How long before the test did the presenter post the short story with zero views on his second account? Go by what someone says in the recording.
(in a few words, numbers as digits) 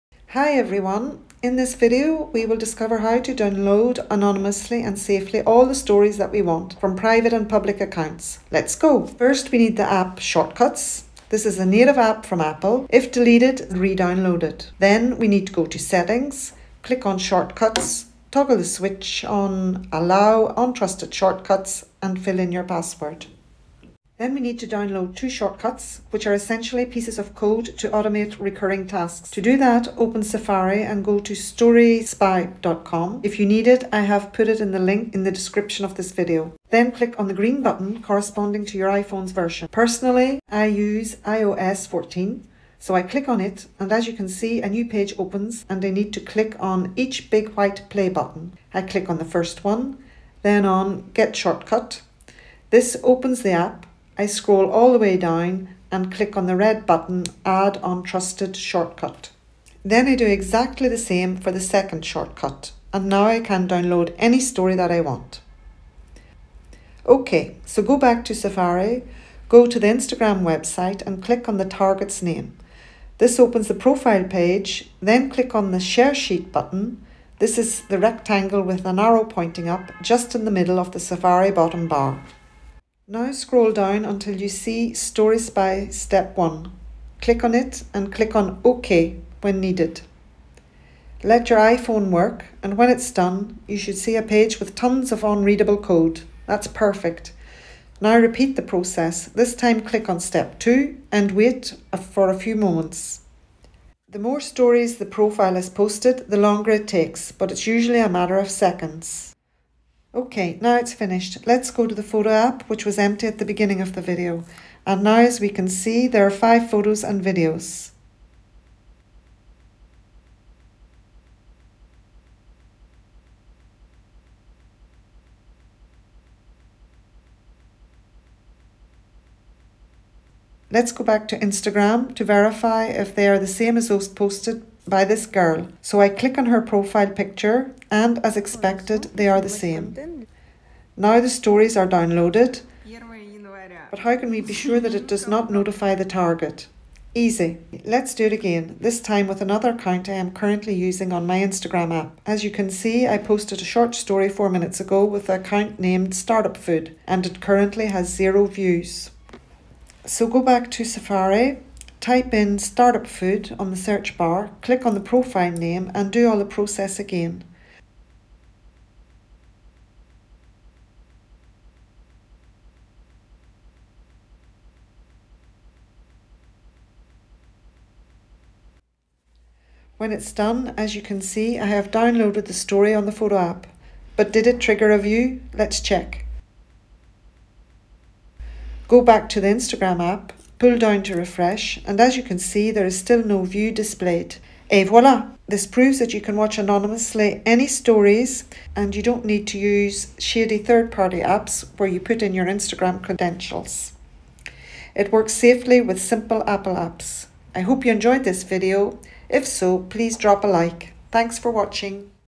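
4 minutes.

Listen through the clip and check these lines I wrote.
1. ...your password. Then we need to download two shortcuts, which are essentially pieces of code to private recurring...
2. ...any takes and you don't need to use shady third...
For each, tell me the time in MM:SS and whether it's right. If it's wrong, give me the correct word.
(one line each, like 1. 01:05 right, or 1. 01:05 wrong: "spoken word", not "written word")
1. 00:22 wrong: "automate", not "private"
2. 03:17 wrong: "stories", not "takes".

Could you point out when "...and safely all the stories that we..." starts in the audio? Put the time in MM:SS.
00:04.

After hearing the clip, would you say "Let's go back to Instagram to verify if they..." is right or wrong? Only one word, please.
right.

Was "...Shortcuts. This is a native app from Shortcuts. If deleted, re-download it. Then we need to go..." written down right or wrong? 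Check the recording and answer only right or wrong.
wrong.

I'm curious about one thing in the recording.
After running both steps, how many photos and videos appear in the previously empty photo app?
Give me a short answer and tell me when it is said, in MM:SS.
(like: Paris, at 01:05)
5, at 01:56.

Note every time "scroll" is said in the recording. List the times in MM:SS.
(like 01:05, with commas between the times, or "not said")
00:54, 01:23.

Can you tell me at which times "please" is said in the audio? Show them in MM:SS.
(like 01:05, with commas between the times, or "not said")
03:29.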